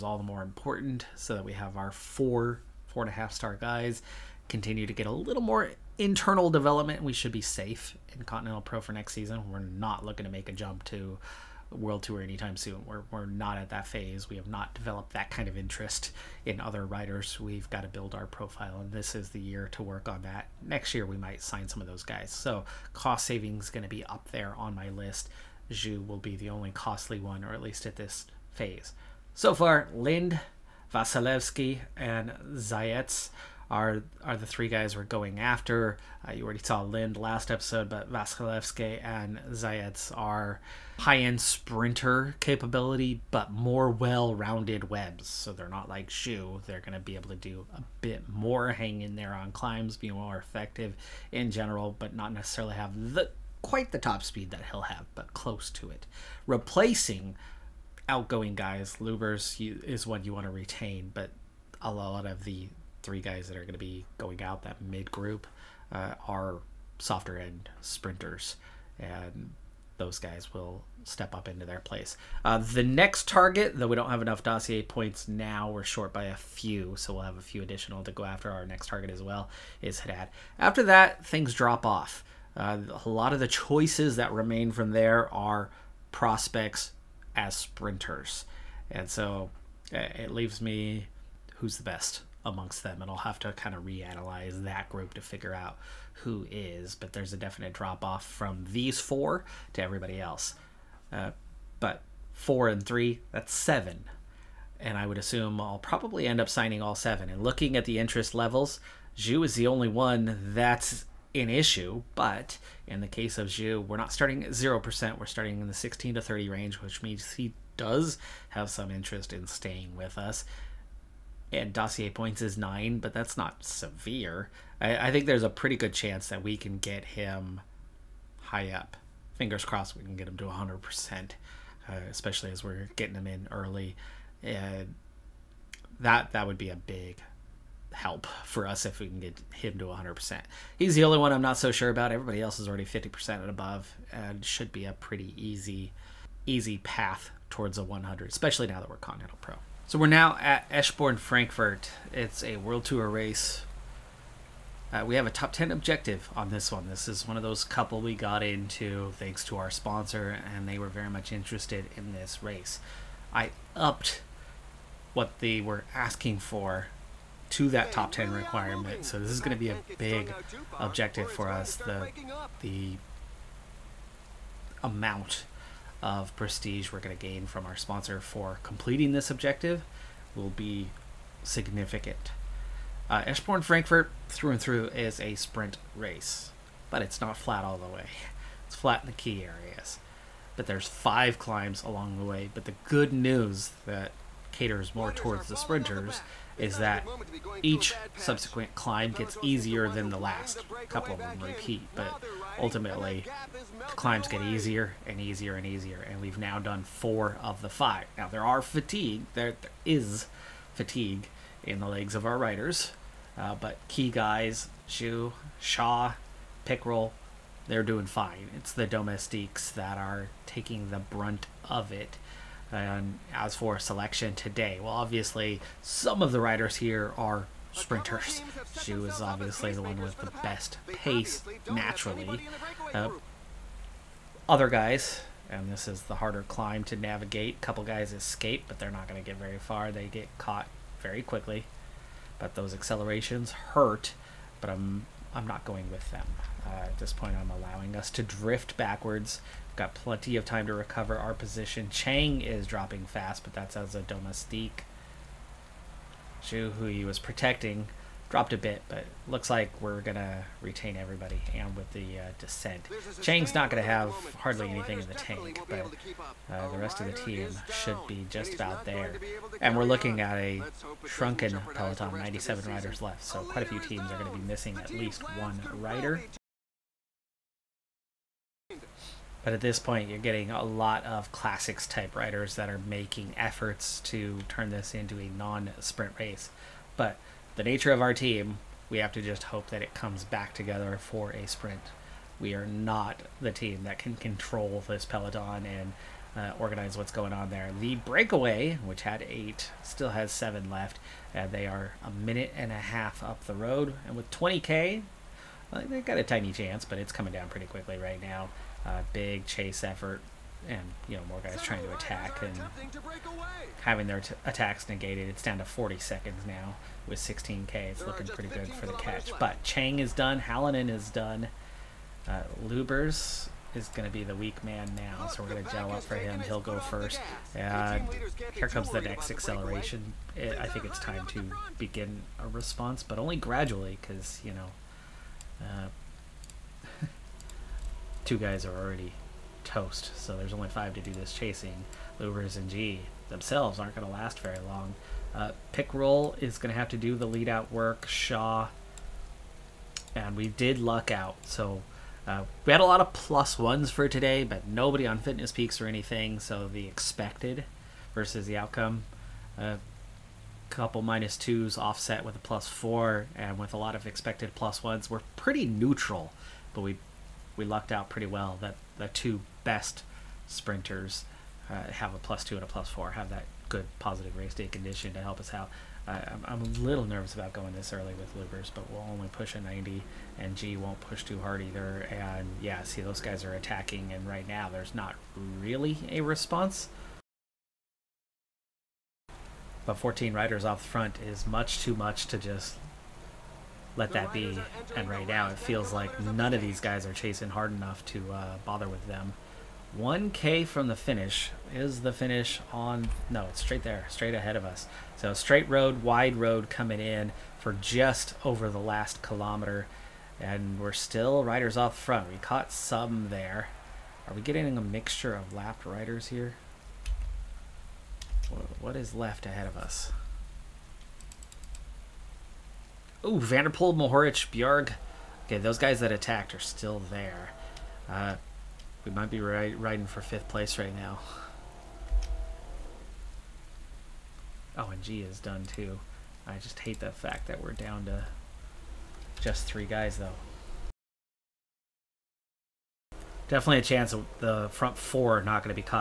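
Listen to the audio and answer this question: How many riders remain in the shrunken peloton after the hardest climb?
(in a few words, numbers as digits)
97.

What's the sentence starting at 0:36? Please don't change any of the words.
Uh, you already saw Lind last episode, but Vasilevsky and Zayets are high-end sprinter capability, but more well-rounded webs.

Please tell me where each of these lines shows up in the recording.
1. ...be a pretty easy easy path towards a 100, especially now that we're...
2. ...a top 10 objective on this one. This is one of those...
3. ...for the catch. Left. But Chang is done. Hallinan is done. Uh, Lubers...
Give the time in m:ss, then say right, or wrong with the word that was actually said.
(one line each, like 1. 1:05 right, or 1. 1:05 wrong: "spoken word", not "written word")
1. 2:24 right
2. 2:35 right
3. 5:18 right.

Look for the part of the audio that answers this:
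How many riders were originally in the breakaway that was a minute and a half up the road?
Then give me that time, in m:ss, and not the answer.
4:59.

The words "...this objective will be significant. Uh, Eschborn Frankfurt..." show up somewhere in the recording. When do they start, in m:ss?
2:59.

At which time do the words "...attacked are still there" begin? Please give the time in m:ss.
7:06.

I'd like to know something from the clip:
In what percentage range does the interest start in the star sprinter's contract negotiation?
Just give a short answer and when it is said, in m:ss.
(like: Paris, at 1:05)
16 to 30, at 1:55.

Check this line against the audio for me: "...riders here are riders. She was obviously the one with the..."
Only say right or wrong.
wrong.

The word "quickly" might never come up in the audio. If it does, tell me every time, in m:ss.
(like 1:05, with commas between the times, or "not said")
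4:01, 5:07.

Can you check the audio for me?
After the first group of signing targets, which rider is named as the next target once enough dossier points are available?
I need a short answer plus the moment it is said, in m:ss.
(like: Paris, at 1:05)
Haddad, at 1:20.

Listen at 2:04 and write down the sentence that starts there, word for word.
I, I think there's a pretty good chance that we can get him high up.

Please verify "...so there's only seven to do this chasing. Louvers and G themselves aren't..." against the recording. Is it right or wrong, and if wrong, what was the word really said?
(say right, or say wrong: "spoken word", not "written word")
wrong: "five", not "seven".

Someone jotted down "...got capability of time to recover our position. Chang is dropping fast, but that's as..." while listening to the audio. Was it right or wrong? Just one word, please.
wrong.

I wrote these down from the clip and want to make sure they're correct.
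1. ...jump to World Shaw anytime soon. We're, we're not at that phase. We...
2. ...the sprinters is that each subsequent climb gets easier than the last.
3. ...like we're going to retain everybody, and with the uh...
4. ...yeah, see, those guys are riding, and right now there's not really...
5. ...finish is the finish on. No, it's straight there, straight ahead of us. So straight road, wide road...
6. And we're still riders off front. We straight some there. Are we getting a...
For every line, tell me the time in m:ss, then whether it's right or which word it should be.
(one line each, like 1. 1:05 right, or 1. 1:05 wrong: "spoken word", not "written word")
1. 0:10 wrong: "Tour", not "Shaw"
2. 3:15 right
3. 4:19 right
4. 6:22 wrong: "attacking", not "riding"
5. 6:40 right
6. 6:50 wrong: "caught", not "straight".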